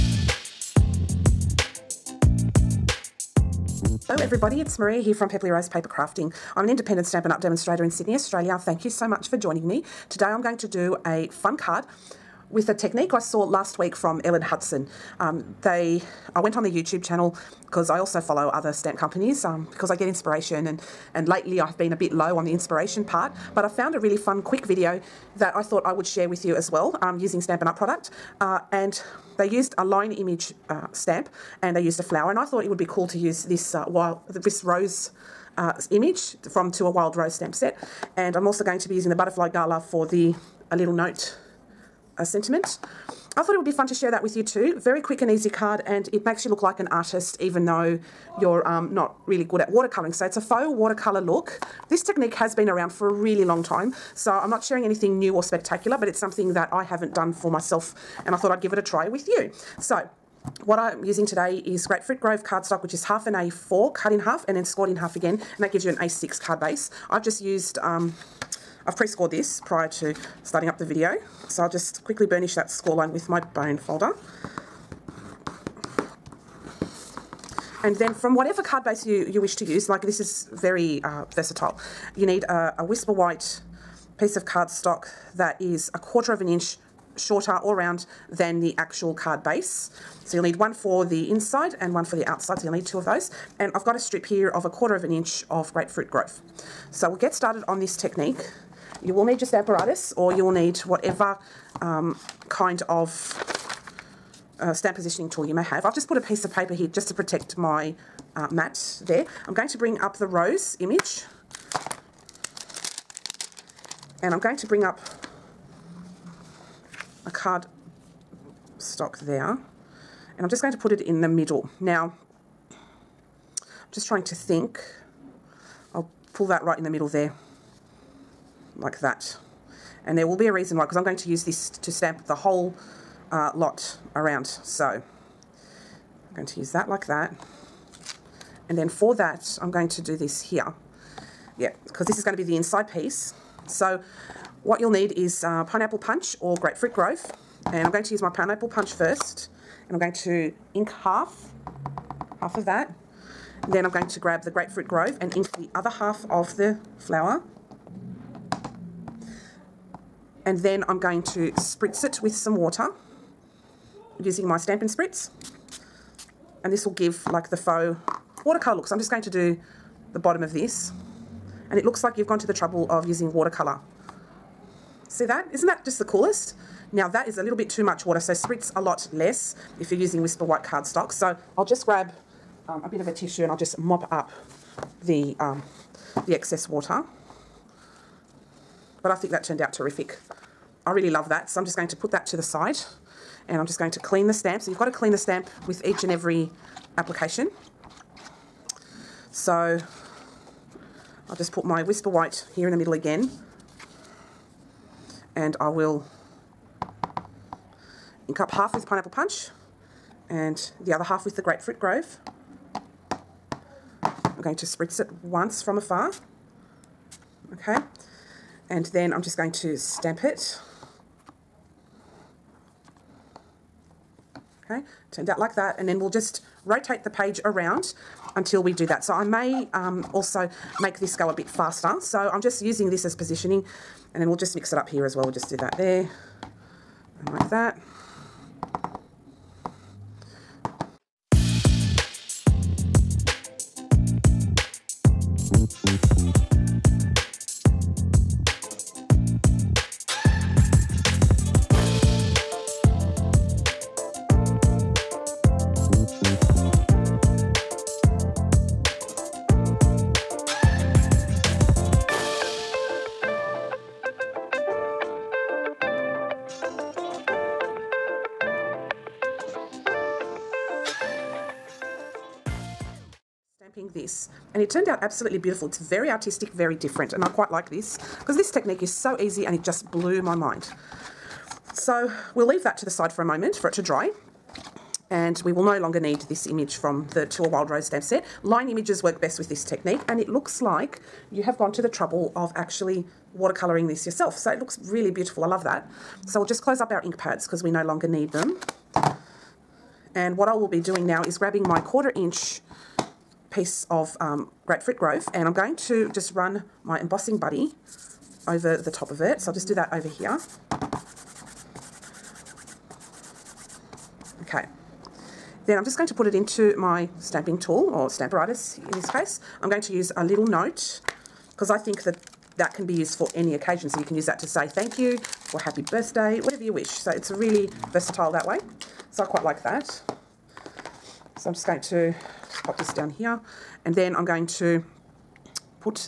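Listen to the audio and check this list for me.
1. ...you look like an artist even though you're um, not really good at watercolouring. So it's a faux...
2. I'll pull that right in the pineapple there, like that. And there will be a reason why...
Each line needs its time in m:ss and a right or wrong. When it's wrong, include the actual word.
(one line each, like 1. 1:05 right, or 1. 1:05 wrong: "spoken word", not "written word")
1. 0:46 right
2. 2:05 wrong: "middle", not "pineapple".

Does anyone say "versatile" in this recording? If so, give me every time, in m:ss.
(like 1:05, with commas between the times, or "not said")
1:21, 5:27.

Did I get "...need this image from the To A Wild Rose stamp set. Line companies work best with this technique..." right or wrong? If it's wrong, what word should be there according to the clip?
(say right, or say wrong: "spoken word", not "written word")
wrong: "images", not "companies".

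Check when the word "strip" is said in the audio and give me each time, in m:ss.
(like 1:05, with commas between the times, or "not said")
1:33.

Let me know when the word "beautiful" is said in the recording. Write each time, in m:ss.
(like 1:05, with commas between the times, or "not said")
4:35, 4:55.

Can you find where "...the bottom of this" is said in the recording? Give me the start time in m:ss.
2:50.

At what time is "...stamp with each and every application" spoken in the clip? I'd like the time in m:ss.
3:15.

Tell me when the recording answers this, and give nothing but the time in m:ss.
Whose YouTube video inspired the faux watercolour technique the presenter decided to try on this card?
0:14.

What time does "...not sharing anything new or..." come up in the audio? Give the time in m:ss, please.
0:54.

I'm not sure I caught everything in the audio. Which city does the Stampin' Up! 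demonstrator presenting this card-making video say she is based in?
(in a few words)
Sydney.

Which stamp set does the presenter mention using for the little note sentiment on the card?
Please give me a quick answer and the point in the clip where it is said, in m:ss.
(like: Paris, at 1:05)
Butterfly Gala, at 0:39.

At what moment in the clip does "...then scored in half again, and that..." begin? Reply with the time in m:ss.
1:04.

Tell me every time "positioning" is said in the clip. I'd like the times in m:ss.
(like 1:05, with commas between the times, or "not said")
1:44, 3:53.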